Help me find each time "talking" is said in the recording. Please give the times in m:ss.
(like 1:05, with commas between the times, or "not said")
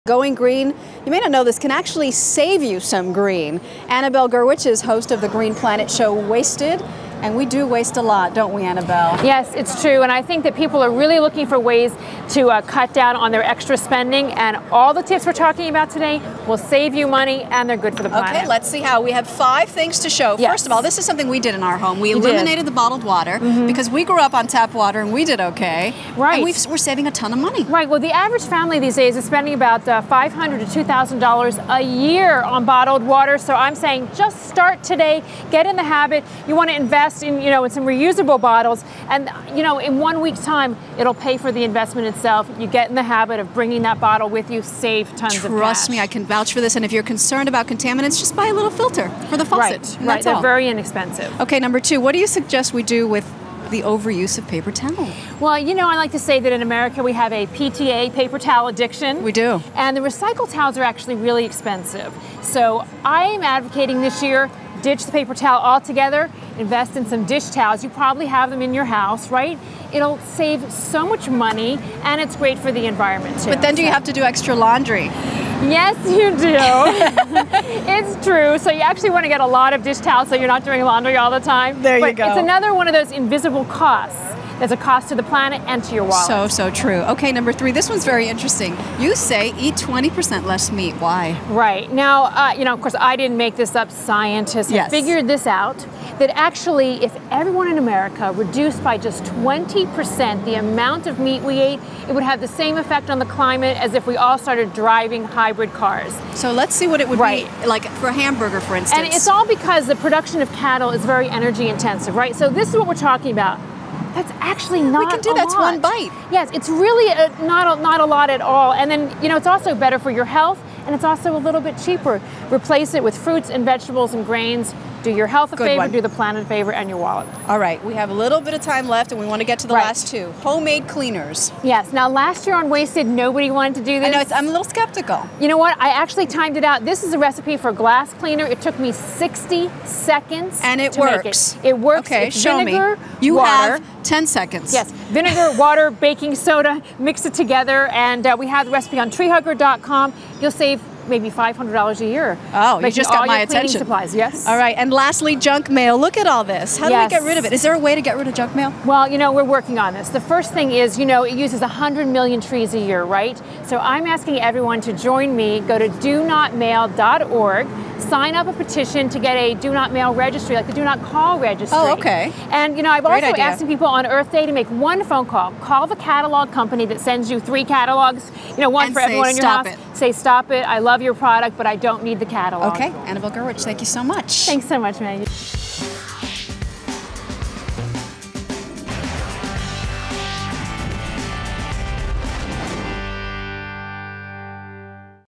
0:15, 1:52.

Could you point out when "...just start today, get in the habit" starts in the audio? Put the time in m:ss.
0:34.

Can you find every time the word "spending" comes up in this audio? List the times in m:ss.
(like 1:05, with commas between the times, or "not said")
0:13, 0:29.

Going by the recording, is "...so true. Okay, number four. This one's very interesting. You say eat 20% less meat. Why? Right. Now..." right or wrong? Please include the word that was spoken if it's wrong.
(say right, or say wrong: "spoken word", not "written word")
wrong: "three", not "four".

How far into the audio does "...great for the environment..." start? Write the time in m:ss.
1:12.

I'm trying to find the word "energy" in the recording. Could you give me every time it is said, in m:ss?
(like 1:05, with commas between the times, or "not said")
1:51.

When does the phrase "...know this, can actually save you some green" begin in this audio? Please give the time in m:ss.
0:01.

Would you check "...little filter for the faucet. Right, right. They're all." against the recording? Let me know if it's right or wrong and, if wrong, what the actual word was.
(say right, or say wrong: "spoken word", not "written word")
right.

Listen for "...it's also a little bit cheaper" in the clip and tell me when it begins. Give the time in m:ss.
2:00.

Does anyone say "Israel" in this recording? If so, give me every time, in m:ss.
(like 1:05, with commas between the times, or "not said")
not said.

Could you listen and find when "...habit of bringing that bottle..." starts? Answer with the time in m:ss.
0:43.